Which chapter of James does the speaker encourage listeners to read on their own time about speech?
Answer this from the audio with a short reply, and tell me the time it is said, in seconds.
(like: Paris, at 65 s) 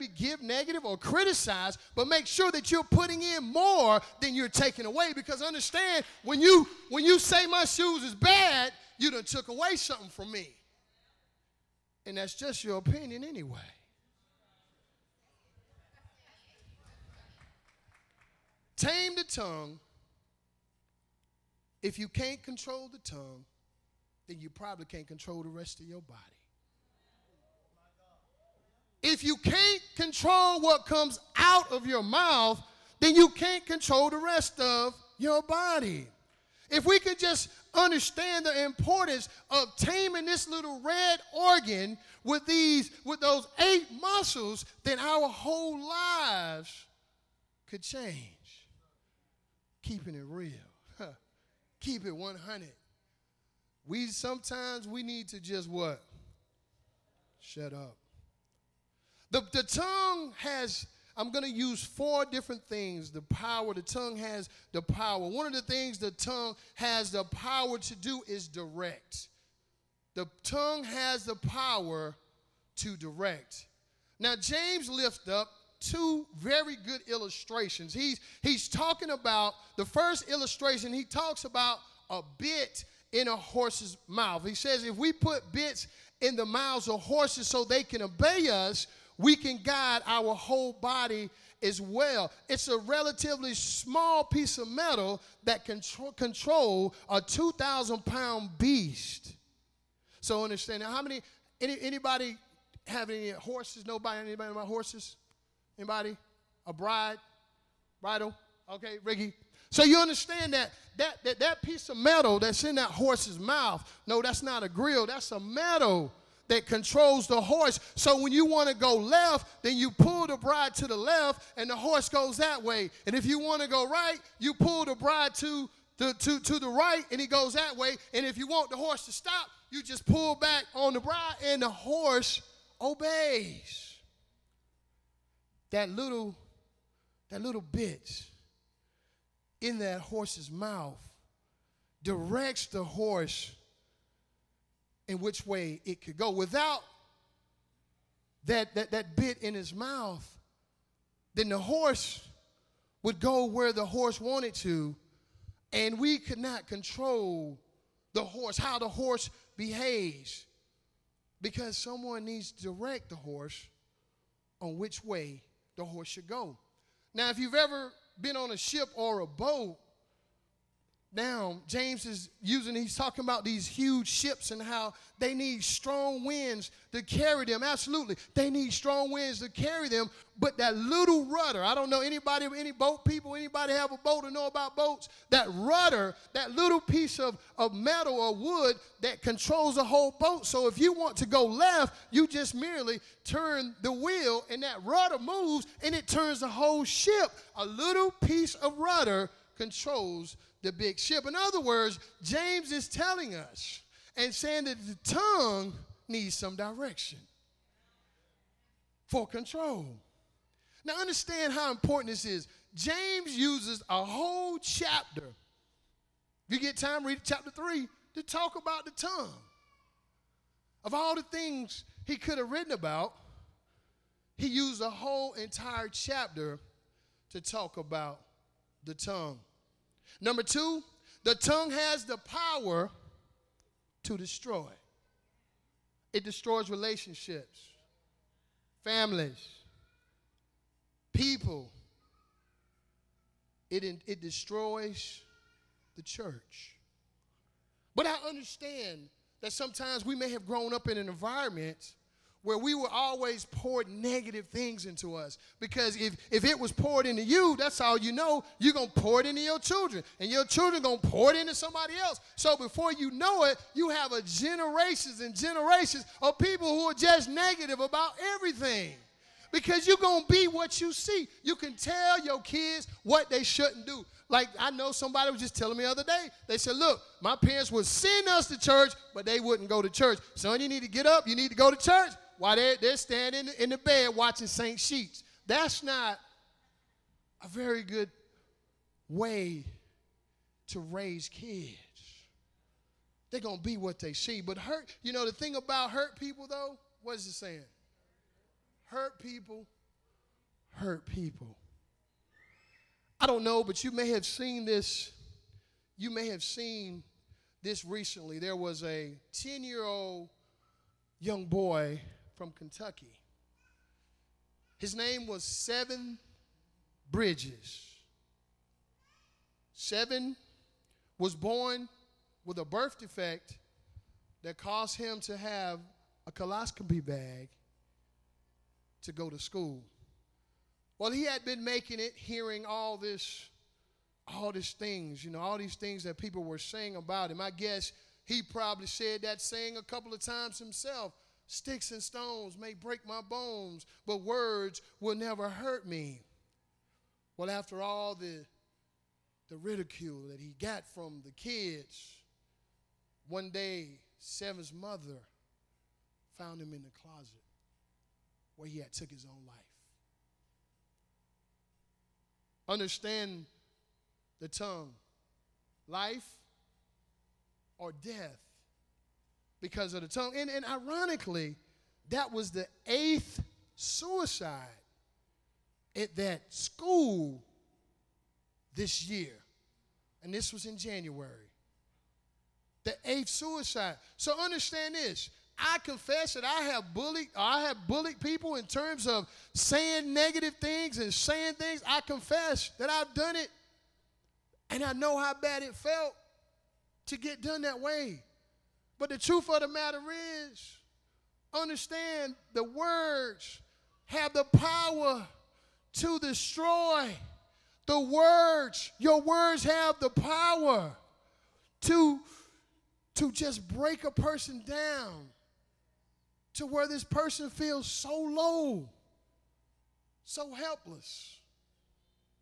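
Chapter 3, at 217 s.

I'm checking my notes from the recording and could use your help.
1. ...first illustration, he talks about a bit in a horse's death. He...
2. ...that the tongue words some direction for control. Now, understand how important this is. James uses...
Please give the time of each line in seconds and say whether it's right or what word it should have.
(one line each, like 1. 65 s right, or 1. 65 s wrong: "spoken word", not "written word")
1. 79 s wrong: "mouth", not "death"
2. 204 s wrong: "needs", not "words".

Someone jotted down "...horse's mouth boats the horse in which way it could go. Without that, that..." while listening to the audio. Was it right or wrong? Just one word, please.
wrong.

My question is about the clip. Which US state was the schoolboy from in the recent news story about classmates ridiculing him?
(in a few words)
Kentucky.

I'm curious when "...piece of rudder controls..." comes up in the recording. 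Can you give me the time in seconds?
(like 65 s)
198 s.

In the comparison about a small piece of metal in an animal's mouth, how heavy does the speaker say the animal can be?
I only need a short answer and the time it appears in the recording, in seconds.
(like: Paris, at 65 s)
2,000 pounds, at 97 s.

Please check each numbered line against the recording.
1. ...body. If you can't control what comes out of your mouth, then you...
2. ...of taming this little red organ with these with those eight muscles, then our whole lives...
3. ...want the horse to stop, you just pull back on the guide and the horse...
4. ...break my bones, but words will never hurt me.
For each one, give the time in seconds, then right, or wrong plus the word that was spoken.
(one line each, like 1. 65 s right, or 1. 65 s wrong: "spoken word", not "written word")
1. 25 s right
2. 39 s right
3. 128 s wrong: "bride", not "guide"
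4. 342 s right.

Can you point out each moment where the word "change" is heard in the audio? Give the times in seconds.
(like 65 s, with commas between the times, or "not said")
47 s.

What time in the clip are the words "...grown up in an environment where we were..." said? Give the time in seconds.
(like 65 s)
250 s.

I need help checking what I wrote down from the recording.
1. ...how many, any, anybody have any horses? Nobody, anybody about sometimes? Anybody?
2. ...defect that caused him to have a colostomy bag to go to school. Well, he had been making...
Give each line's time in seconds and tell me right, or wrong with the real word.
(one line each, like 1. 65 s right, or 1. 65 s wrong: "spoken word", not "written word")
1. 100 s wrong: "horses", not "sometimes"
2. 322 s right.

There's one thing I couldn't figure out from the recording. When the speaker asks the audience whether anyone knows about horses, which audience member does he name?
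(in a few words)
Ricky.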